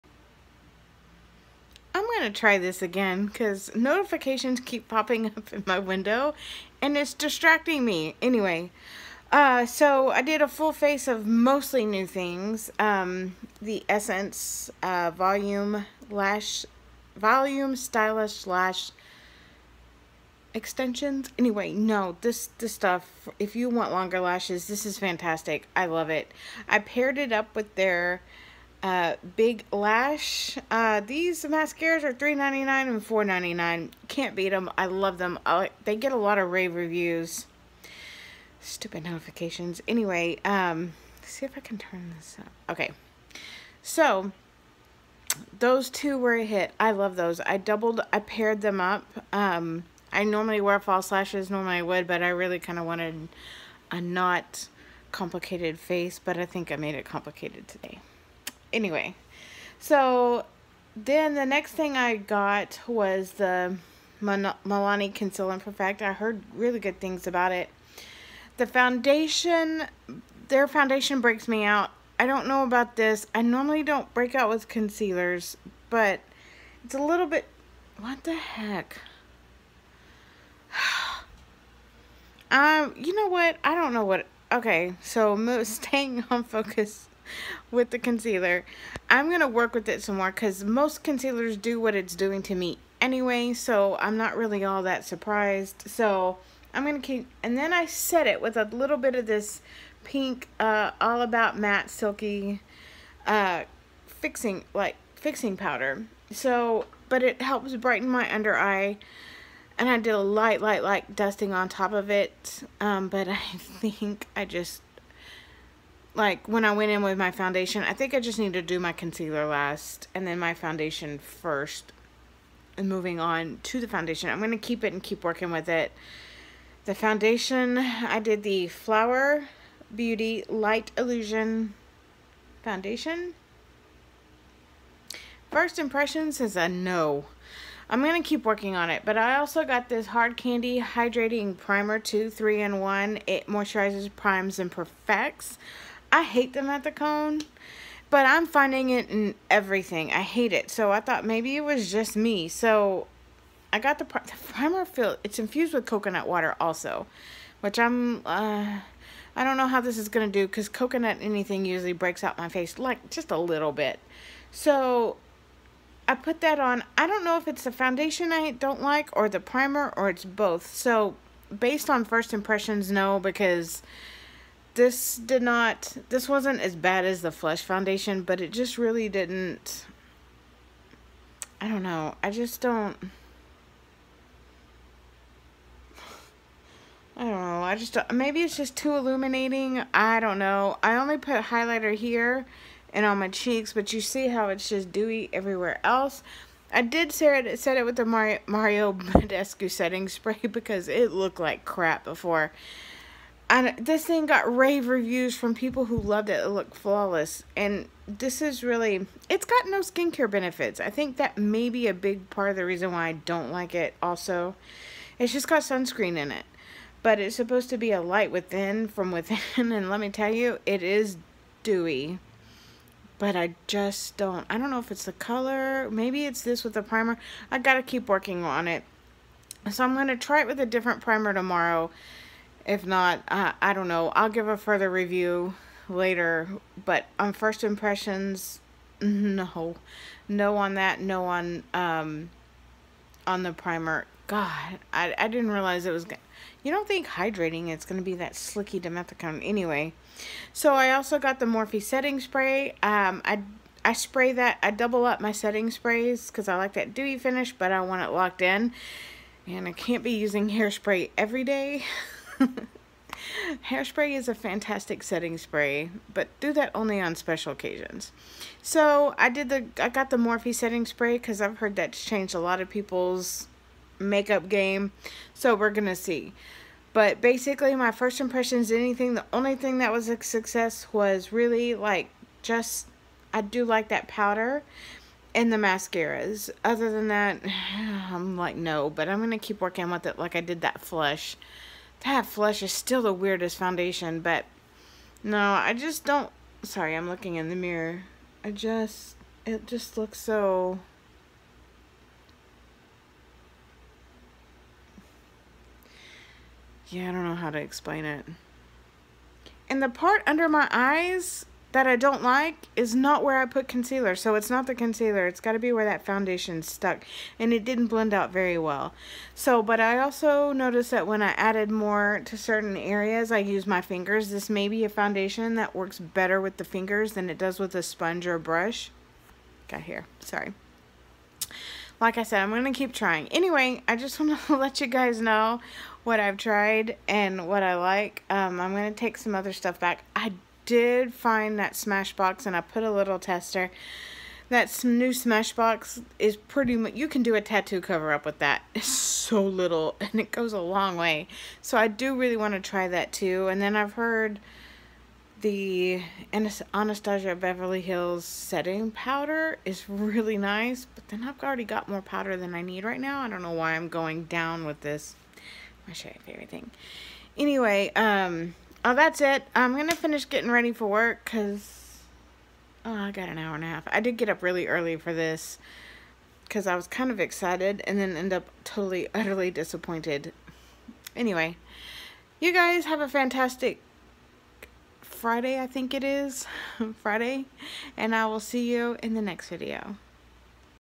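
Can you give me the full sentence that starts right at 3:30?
I think that may be a big part of the reason why I don't like it also.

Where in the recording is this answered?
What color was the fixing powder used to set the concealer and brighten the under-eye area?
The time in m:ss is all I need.
1:40.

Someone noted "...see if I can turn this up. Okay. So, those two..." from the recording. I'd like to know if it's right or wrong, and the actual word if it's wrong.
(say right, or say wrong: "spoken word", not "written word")
right.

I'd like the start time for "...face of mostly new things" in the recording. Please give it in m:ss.
0:10.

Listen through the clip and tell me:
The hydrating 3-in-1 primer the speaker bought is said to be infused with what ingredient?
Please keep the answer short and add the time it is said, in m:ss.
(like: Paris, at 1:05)
coconut water, at 2:35.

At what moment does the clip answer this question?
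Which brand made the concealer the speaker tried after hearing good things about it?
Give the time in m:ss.
1:04.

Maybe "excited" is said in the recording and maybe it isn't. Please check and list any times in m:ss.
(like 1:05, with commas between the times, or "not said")
6:17.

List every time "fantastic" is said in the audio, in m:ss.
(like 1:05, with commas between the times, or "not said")
0:24, 4:24, 6:23.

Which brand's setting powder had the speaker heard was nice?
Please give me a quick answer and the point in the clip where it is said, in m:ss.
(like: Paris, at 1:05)
Anastasia Beverly Hills, at 5:56.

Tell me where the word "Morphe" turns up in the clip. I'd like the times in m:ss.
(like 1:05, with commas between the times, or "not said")
4:11, 4:30.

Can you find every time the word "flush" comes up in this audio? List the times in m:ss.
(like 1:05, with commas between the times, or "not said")
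4:50.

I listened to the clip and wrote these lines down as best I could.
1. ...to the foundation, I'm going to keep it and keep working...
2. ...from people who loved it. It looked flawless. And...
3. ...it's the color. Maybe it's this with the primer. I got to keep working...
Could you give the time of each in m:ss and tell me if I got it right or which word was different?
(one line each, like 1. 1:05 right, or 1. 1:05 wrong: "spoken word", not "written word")
1. 2:03 right
2. 3:25 right
3. 3:44 right.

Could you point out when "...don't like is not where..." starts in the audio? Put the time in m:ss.
5:11.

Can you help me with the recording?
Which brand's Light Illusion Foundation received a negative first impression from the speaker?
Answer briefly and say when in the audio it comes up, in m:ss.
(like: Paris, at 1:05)
Flower Beauty, at 2:08.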